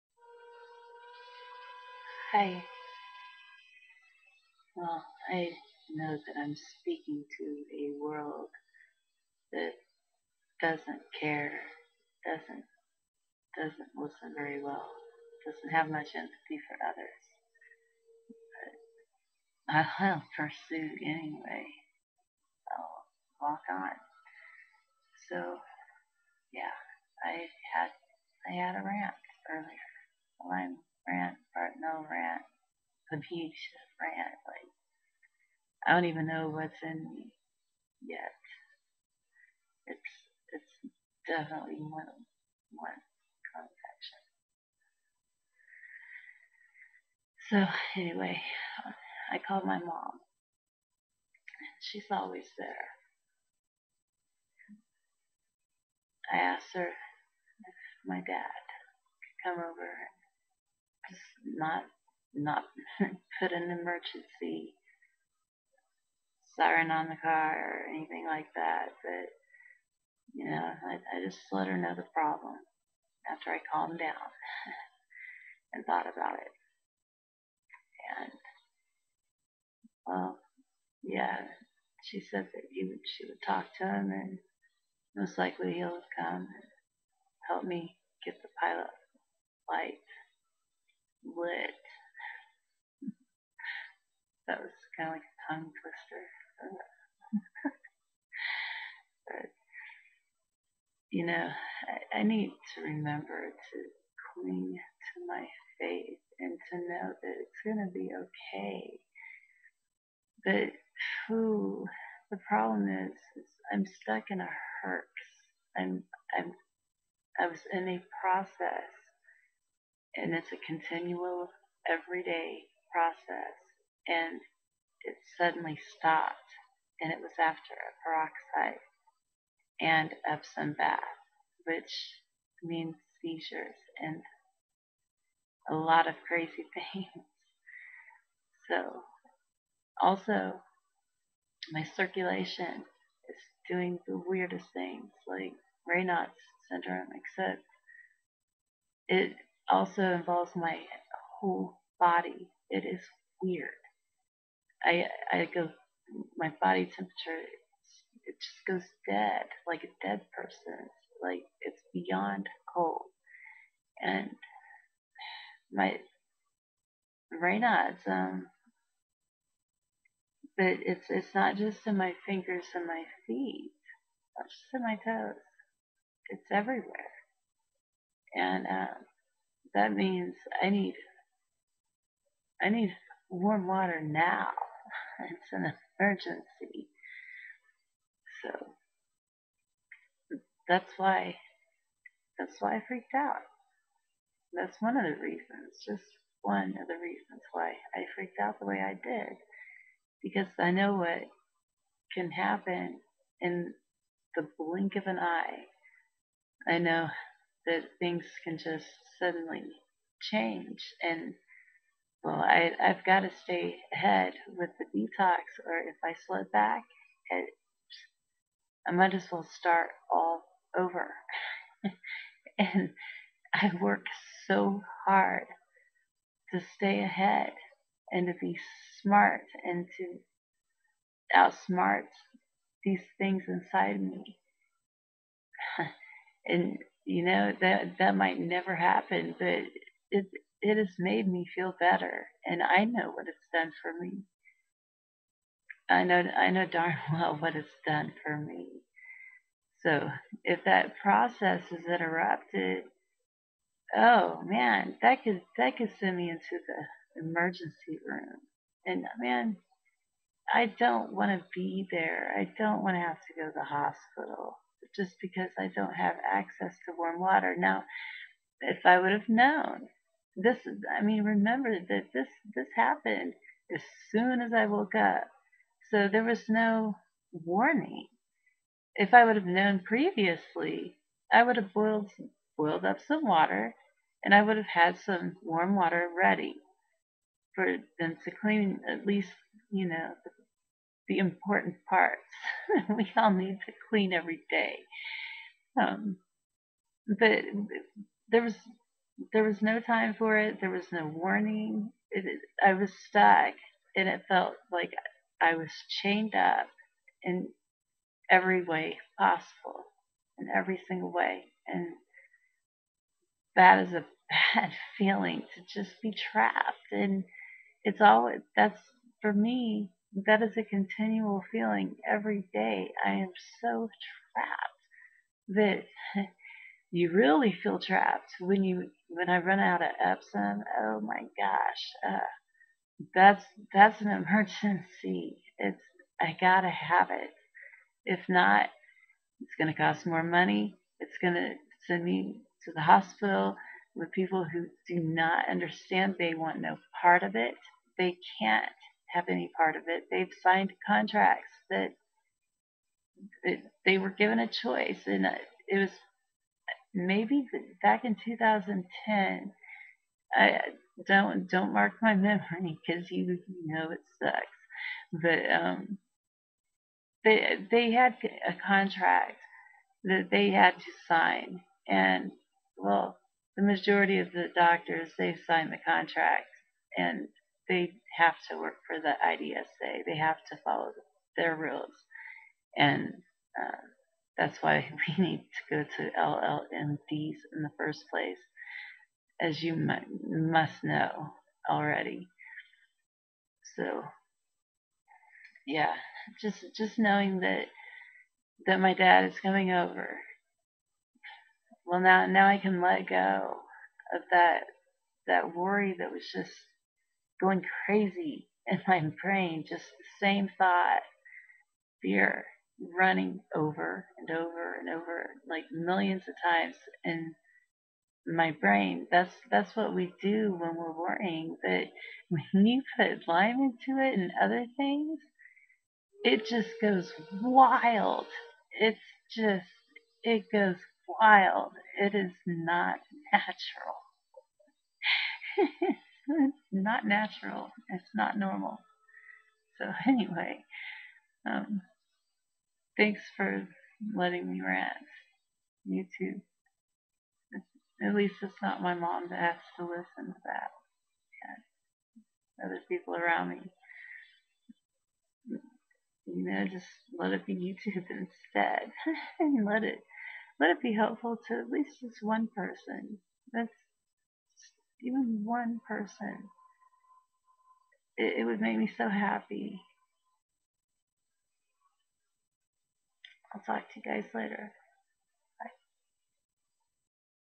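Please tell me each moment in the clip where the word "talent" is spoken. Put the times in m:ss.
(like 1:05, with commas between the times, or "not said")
not said.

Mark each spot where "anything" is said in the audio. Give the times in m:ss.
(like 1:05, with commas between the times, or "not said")
1:07.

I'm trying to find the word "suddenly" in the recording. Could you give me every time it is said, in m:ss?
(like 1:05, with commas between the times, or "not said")
2:05, 3:29.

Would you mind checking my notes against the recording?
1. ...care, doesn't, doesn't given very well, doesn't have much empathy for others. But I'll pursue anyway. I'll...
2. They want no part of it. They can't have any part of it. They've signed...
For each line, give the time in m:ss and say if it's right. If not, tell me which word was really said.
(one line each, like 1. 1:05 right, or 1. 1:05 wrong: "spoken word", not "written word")
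1. 0:11 wrong: "listen", not "given"
2. 5:46 right.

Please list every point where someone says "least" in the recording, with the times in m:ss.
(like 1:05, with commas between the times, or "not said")
4:49, 7:28, 7:41.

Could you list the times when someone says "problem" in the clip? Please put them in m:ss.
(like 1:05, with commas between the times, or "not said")
1:12, 1:52.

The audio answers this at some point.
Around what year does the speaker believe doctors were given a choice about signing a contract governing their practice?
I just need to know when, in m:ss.
5:58.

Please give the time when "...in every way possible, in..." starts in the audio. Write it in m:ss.
5:07.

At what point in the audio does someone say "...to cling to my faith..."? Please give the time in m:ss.
1:43.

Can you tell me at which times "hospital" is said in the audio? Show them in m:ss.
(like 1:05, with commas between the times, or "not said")
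4:23, 5:42.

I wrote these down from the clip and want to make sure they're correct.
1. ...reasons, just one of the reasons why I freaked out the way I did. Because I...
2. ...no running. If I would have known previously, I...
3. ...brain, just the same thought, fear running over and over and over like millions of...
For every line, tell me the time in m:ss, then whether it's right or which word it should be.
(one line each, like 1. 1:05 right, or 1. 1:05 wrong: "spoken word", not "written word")
1. 3:15 right
2. 4:36 wrong: "warning", not "running"
3. 6:49 right.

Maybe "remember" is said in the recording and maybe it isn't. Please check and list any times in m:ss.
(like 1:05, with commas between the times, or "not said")
1:42, 4:31.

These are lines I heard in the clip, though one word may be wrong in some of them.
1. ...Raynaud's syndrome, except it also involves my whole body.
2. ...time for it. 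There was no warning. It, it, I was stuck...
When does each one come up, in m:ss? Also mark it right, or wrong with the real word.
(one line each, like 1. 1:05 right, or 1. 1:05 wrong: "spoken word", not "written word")
1. 2:25 right
2. 4:59 right.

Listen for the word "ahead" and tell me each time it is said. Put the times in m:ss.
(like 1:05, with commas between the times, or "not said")
3:33, 3:47.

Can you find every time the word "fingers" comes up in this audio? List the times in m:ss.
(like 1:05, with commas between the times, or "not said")
2:52.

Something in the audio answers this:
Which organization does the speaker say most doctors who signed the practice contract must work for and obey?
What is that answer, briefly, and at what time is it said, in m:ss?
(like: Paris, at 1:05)
IDSA, at 6:19.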